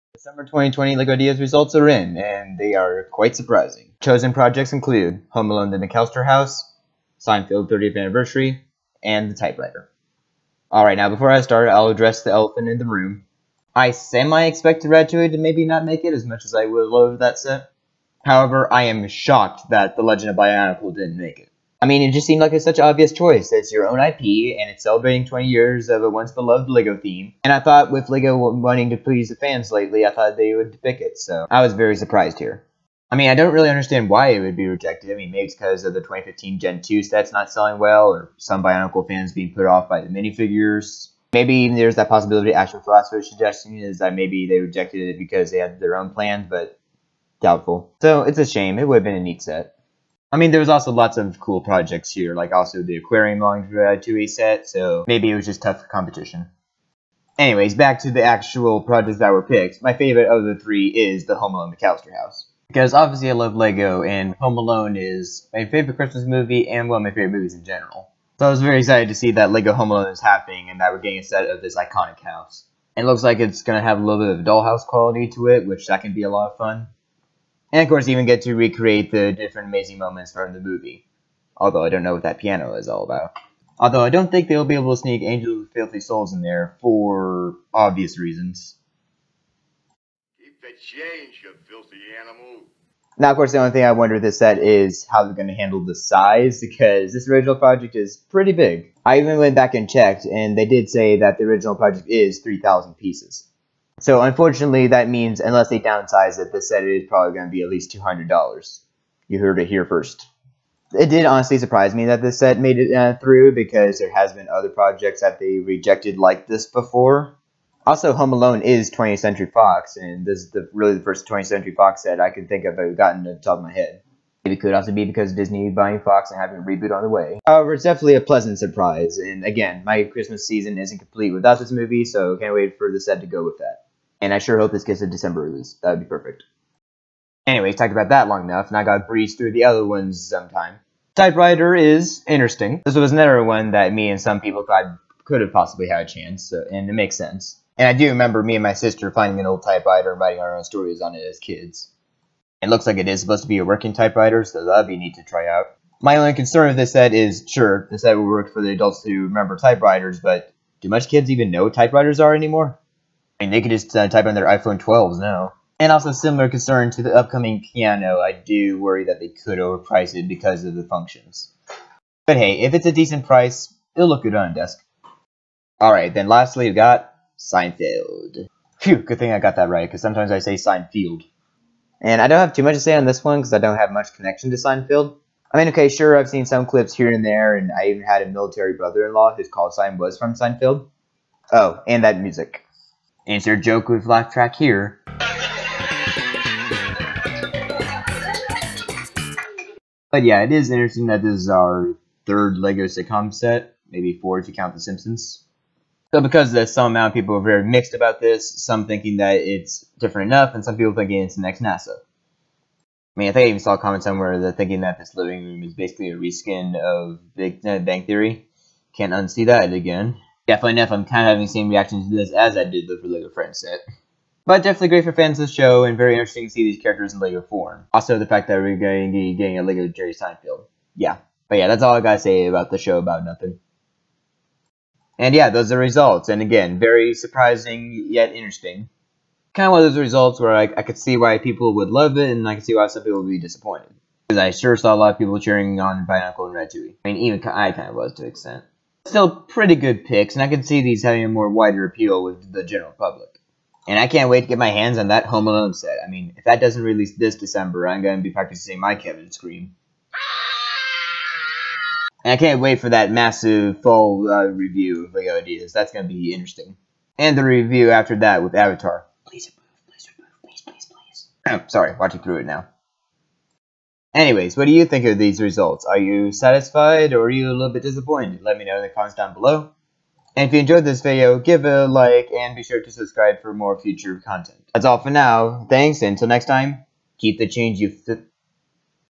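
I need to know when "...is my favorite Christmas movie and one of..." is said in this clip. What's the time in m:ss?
1:04.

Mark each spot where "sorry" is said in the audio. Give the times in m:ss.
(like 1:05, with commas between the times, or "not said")
4:31.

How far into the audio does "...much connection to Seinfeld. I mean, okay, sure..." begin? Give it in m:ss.
3:03.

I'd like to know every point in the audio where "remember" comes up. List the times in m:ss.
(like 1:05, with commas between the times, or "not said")
2:28, 2:39.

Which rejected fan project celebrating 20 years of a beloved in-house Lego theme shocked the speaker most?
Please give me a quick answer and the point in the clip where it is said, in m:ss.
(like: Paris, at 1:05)
The Legend of Bionicle, at 0:19.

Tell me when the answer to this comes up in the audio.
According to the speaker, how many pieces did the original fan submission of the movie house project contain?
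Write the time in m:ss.
1:42.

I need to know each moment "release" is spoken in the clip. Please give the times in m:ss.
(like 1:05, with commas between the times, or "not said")
2:15, 4:16.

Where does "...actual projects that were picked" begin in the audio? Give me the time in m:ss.
0:58.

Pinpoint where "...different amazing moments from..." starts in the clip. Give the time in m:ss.
1:19.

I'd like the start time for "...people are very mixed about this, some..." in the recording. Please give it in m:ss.
3:27.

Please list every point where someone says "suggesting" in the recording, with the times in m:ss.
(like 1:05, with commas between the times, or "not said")
0:43.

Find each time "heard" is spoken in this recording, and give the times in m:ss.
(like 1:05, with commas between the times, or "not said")
1:49.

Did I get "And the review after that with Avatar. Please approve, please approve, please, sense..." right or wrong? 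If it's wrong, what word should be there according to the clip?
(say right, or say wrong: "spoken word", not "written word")
wrong: "please", not "sense".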